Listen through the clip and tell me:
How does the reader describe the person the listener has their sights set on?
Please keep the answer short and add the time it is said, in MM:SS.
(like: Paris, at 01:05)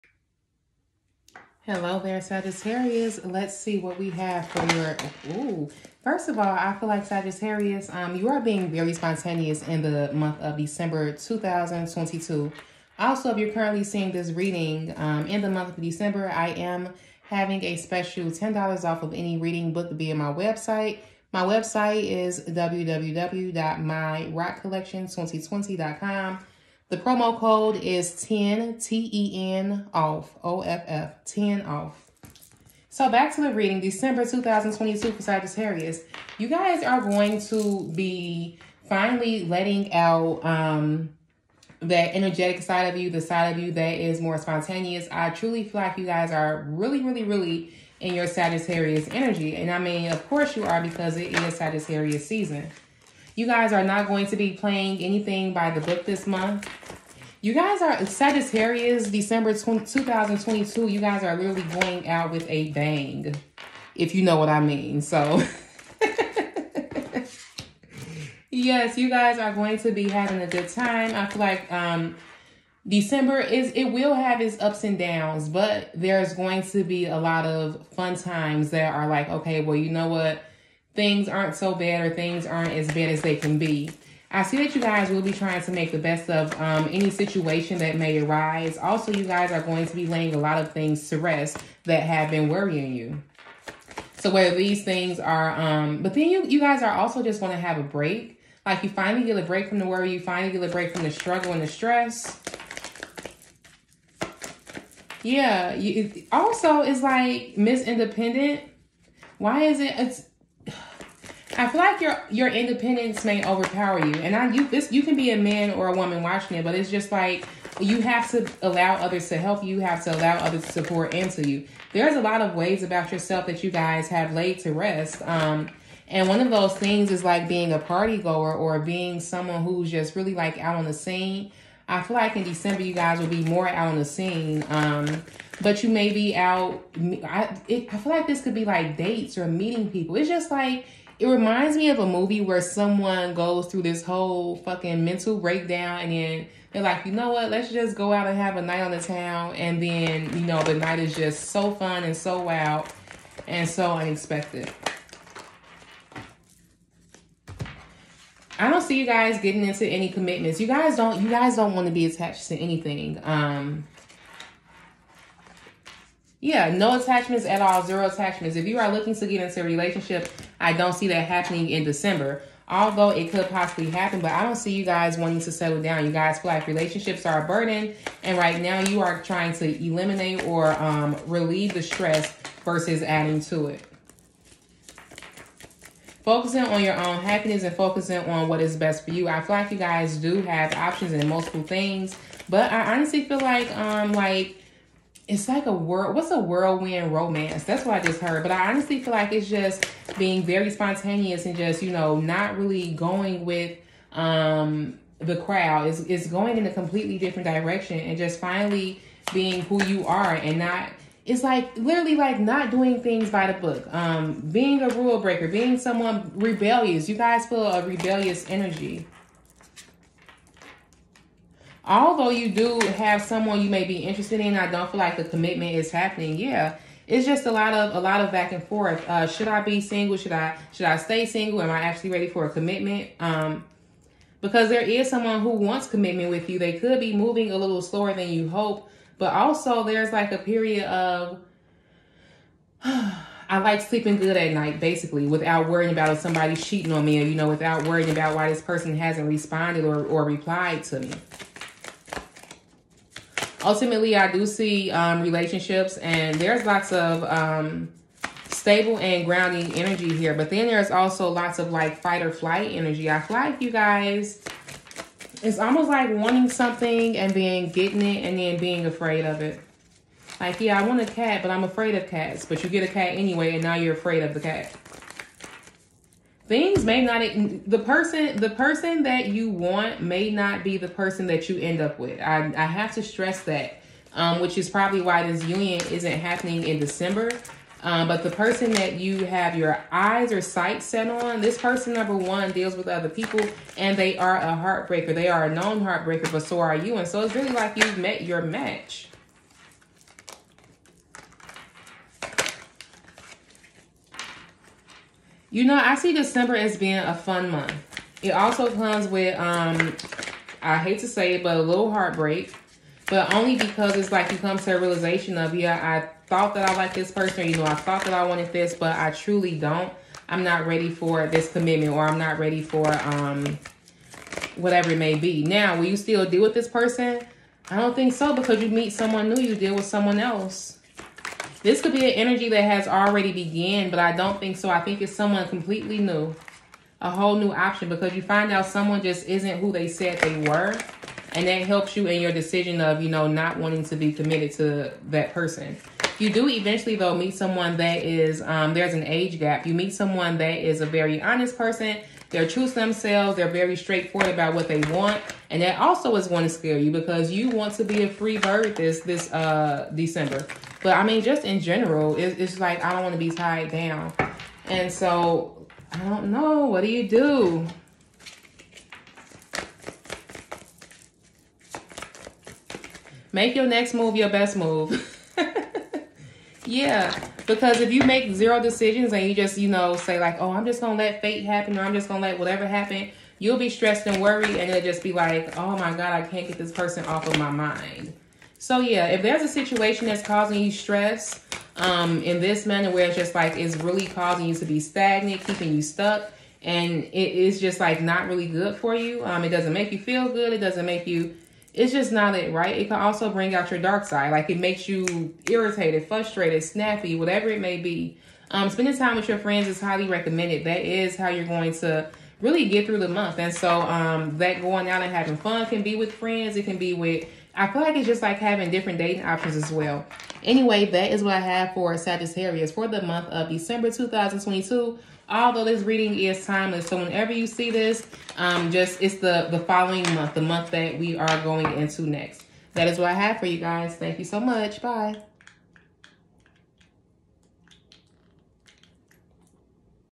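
a known heartbreaker, at 04:55.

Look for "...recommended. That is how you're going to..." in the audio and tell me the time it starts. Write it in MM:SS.
06:50.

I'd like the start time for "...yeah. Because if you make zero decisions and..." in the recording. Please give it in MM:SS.
06:16.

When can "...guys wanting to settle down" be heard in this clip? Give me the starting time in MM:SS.
02:54.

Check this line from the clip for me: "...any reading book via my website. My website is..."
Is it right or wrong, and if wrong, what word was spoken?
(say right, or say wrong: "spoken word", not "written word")
right.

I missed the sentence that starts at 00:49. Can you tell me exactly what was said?
And I mean, of course you are because it is Sagittarius season.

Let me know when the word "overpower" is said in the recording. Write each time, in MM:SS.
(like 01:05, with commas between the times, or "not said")
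01:53.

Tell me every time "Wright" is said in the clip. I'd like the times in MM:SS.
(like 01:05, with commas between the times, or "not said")
not said.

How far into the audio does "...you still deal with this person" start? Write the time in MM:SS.
05:25.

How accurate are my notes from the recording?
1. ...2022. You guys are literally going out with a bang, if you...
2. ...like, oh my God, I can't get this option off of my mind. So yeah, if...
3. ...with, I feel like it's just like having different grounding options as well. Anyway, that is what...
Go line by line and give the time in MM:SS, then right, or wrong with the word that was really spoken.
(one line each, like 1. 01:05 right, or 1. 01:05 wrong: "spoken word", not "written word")
1. 00:59 right
2. 06:25 wrong: "person", not "option"
3. 06:56 wrong: "dating", not "grounding".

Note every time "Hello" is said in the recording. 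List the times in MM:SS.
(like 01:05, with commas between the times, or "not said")
00:01.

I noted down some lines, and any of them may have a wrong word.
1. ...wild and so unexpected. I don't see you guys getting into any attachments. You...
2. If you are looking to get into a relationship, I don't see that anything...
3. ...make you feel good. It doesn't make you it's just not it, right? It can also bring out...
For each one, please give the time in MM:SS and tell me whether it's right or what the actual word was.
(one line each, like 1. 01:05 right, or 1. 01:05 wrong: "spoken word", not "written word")
1. 02:32 wrong: "commitments", not "attachments"
2. 02:48 wrong: "happening", not "anything"
3. 06:39 right.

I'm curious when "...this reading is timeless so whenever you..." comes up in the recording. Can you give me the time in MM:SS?
07:05.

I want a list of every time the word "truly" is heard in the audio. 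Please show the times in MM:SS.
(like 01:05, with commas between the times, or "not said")
00:45, 05:19.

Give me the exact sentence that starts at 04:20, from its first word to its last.
But then there's also lots of like fight or flight energy.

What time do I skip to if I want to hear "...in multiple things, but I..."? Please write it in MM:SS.
03:11.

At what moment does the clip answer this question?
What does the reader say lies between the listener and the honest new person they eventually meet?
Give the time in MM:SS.
05:48.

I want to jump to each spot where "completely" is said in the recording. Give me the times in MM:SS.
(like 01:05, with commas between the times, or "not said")
03:26, 05:35.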